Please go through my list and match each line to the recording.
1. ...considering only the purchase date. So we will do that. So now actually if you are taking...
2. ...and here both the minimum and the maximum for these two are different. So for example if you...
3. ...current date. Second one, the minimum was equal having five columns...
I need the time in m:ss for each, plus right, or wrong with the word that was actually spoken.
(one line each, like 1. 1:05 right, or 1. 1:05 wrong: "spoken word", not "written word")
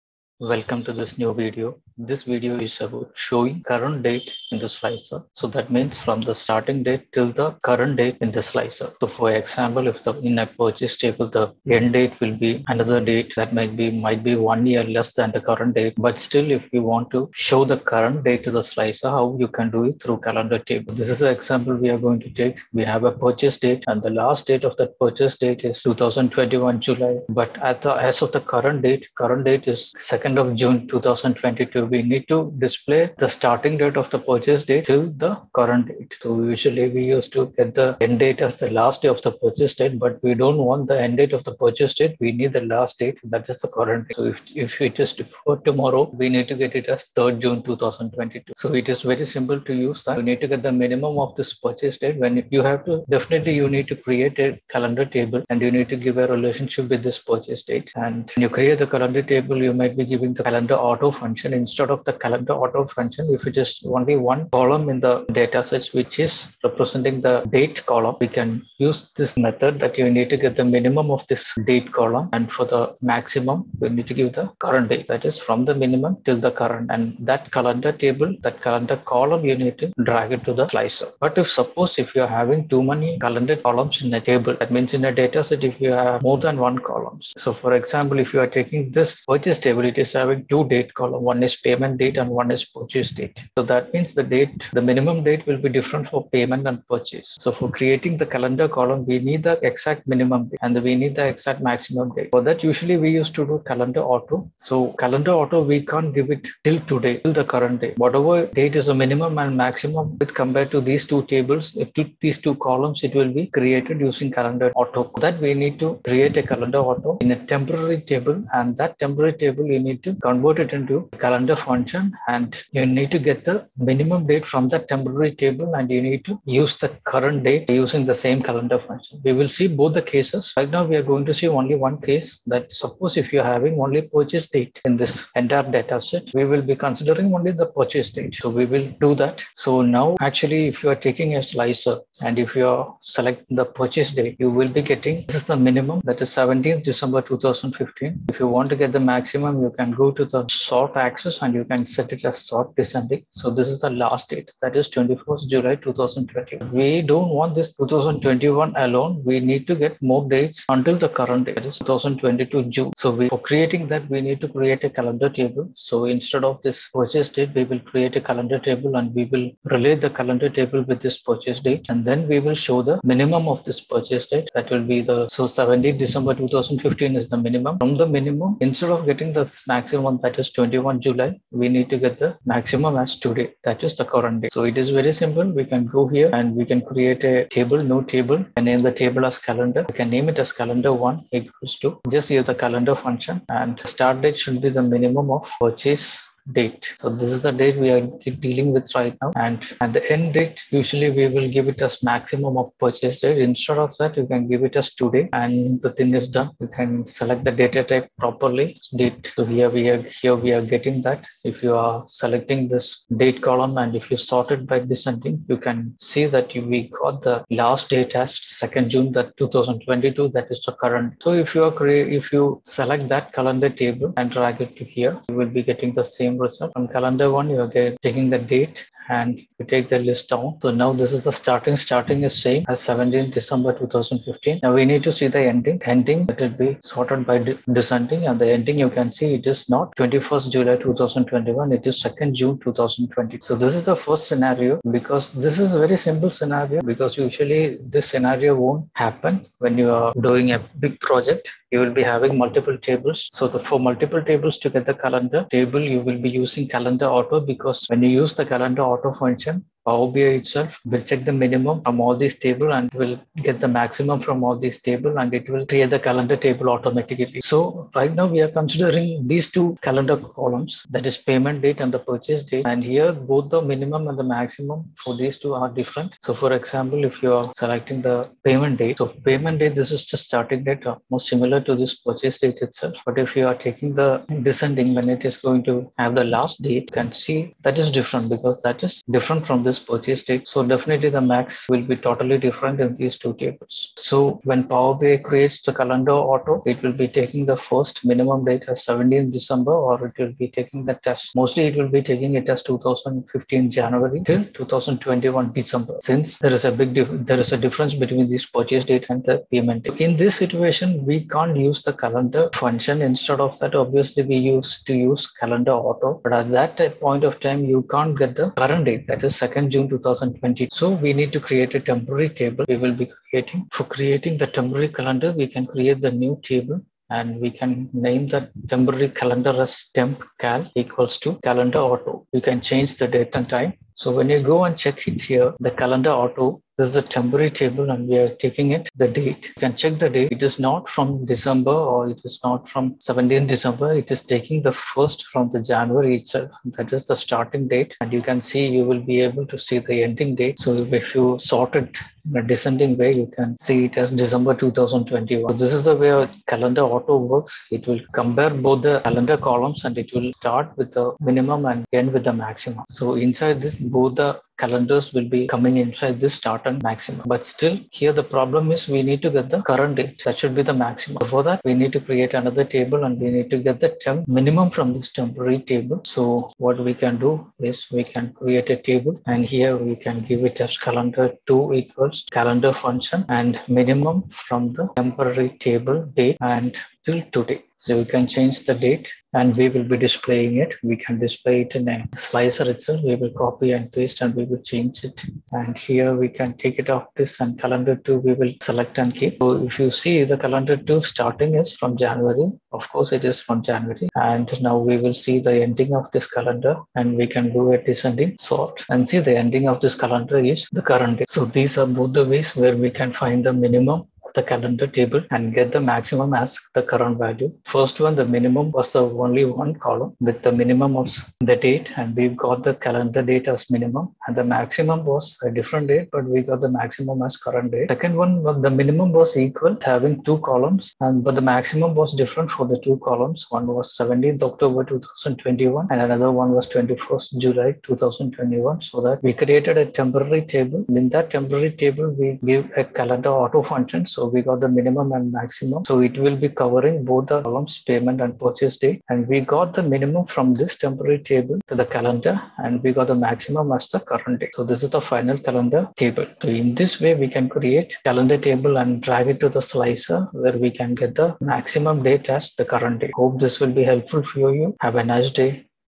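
1. 2:16 right
2. 4:32 right
3. 7:07 wrong: "two", not "five".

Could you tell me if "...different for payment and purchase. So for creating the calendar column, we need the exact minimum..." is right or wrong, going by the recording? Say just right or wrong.
right.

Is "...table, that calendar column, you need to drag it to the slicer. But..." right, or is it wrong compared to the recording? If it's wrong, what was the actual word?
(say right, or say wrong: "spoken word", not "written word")
right.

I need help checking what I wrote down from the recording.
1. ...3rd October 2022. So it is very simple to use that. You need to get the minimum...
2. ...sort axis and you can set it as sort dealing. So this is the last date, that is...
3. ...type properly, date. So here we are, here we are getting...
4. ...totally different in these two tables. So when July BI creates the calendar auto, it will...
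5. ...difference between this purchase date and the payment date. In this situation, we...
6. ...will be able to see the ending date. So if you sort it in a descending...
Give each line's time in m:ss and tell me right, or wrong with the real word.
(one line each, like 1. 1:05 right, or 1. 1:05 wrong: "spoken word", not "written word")
1. 0:47 wrong: "June", not "October"
2. 2:30 wrong: "descending", not "dealing"
3. 3:27 right
4. 4:52 wrong: "Power", not "July"
5. 5:07 right
6. 5:48 right.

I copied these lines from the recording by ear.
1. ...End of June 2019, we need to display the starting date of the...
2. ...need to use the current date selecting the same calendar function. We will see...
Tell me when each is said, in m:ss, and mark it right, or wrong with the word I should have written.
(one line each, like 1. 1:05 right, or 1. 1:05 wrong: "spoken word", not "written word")
1. 0:30 wrong: "2022", not "2019"
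2. 2:06 wrong: "using", not "selecting".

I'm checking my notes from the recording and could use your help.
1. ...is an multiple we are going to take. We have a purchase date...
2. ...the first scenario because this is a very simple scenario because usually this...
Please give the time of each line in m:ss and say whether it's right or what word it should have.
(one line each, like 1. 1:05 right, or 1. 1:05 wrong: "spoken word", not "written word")
1. 0:21 wrong: "example", not "multiple"
2. 4:03 right.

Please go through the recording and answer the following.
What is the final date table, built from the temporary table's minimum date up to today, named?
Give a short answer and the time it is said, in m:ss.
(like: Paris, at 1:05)
calendar 2, at 6:20.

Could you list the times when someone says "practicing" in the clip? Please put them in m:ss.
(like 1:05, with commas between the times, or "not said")
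not said.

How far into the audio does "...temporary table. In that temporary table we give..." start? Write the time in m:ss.
7:19.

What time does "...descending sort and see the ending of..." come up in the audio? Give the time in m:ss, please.
6:47.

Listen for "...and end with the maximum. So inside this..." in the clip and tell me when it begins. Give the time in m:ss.
6:01.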